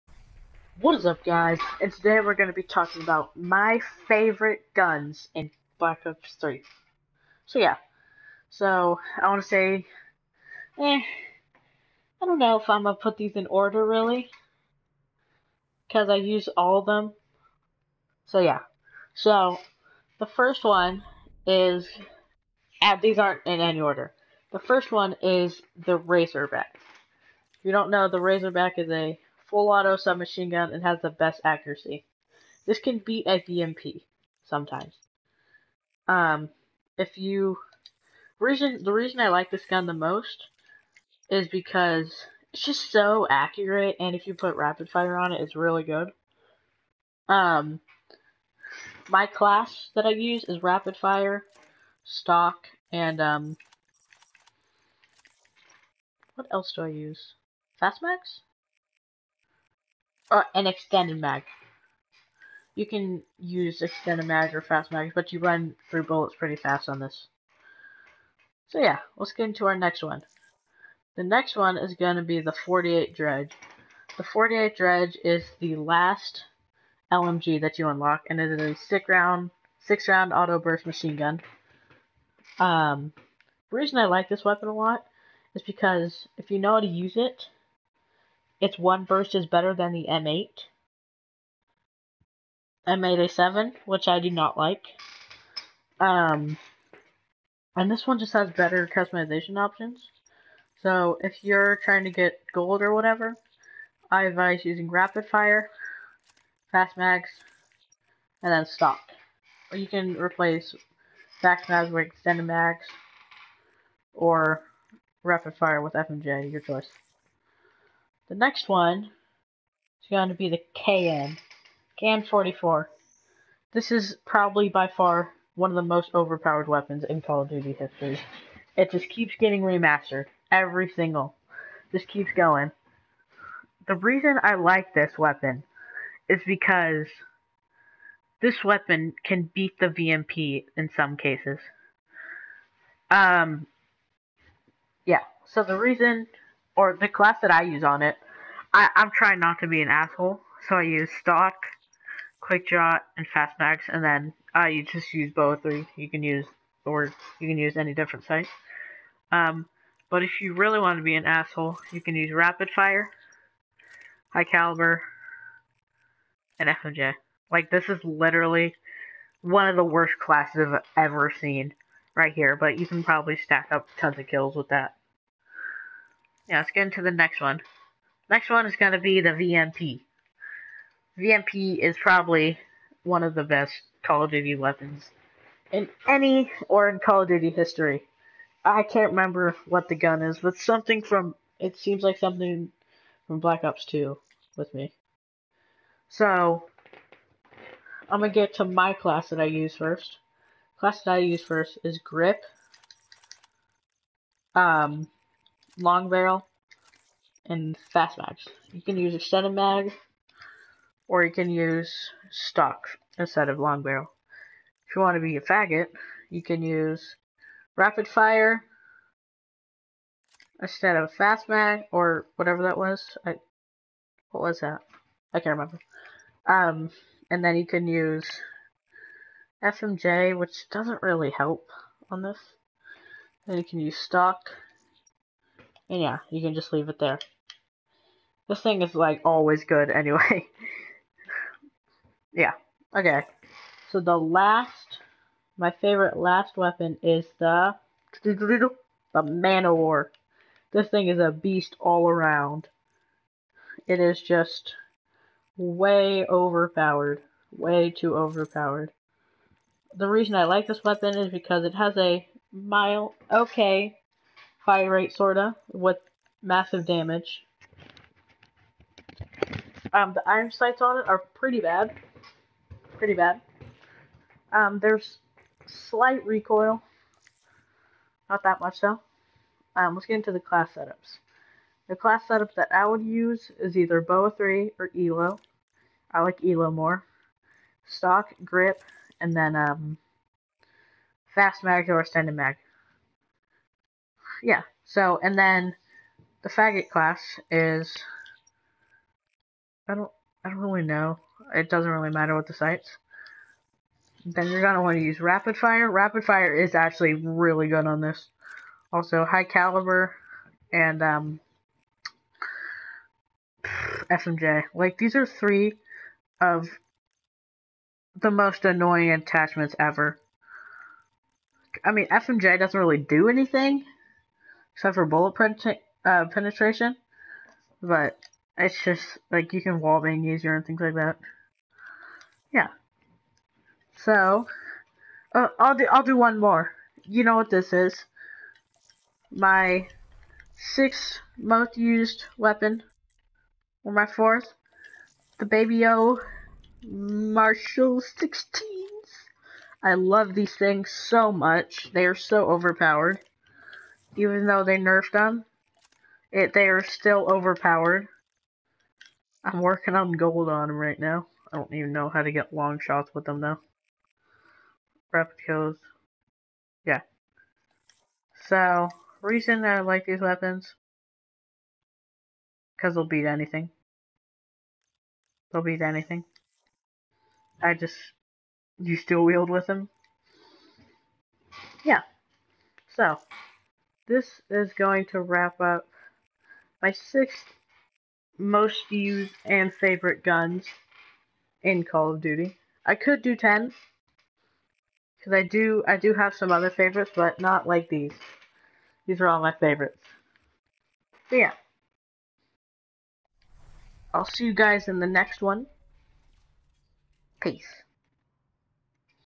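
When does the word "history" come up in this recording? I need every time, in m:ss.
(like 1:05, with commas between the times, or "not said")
2:07, 3:07.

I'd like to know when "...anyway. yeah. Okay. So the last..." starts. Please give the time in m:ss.
3:59.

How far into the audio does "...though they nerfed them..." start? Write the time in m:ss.
5:54.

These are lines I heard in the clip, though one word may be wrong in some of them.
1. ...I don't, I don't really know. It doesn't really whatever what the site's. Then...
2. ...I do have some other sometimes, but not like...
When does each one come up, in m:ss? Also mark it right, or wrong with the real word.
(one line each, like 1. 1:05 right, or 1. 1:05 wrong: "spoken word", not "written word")
1. 4:59 wrong: "matter", not "whatever"
2. 6:35 wrong: "favorites", not "sometimes".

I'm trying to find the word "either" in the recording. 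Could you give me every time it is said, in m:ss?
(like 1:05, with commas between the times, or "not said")
4:43.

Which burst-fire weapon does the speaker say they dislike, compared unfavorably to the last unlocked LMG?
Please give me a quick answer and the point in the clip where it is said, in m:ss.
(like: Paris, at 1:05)
M8A7, at 1:32.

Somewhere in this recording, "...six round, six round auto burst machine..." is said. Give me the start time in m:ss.
1:18.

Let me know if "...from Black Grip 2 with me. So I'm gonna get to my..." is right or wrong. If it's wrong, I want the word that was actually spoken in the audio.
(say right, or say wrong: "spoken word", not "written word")
wrong: "Ops", not "Grip".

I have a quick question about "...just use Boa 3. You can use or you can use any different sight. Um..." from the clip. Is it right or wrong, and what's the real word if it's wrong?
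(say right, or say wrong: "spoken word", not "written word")
right.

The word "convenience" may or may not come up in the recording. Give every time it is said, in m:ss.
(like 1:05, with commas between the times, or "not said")
not said.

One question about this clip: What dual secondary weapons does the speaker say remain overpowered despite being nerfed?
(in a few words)
Marshal 16s.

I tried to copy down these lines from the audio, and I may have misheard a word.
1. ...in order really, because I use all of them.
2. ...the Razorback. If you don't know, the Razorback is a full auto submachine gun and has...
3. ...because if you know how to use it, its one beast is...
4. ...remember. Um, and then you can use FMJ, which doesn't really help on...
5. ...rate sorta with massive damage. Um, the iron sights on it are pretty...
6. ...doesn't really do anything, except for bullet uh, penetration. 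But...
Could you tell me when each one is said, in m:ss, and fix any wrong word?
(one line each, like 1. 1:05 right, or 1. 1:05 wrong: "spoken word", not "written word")
1. 0:13 right
2. 0:25 right
3. 1:25 wrong: "burst", not "beast"
4. 3:45 right
5. 4:24 right
6. 5:22 right.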